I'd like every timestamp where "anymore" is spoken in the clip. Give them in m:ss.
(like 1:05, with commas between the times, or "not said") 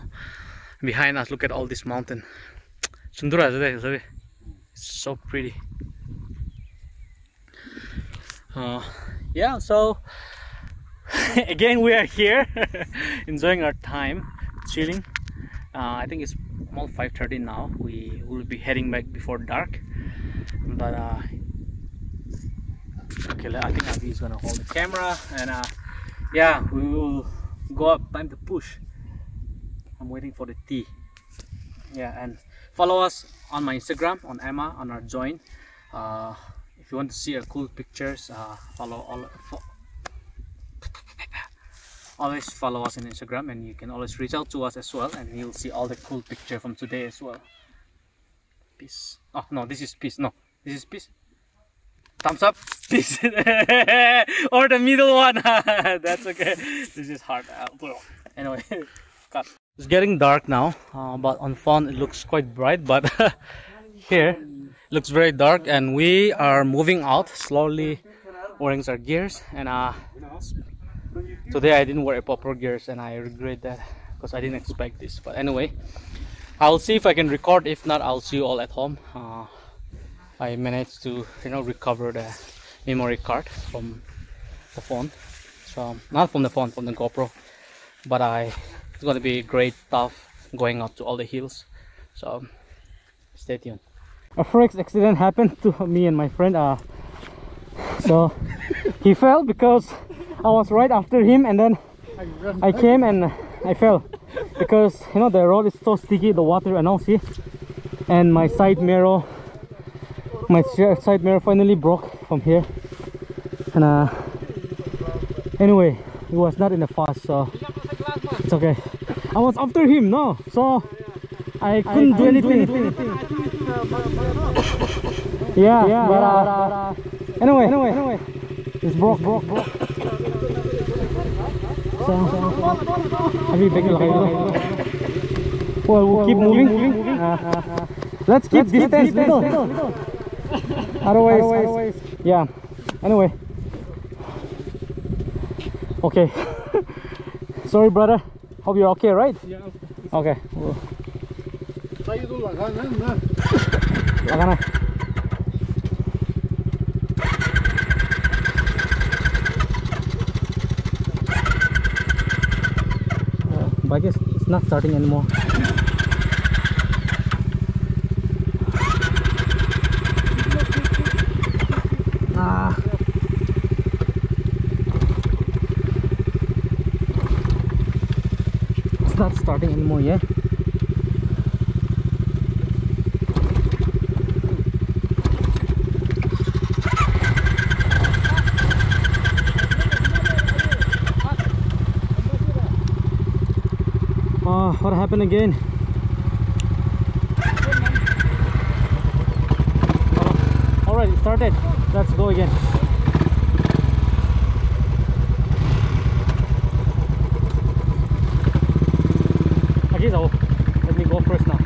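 2:44, 2:59.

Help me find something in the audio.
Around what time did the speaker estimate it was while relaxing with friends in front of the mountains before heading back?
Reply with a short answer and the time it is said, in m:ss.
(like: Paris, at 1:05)
5:30, at 0:16.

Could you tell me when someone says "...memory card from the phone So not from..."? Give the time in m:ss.
1:22.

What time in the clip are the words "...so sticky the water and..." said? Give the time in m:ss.
1:45.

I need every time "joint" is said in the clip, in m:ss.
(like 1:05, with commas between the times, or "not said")
0:35.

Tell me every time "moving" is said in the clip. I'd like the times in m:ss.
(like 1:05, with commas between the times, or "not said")
1:06, 2:16.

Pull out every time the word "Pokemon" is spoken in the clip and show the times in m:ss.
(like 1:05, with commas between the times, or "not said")
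not said.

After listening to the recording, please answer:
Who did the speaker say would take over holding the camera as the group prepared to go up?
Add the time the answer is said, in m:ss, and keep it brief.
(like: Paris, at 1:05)
Avi, at 0:23.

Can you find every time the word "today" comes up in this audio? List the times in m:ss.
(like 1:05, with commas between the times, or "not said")
0:46, 1:11.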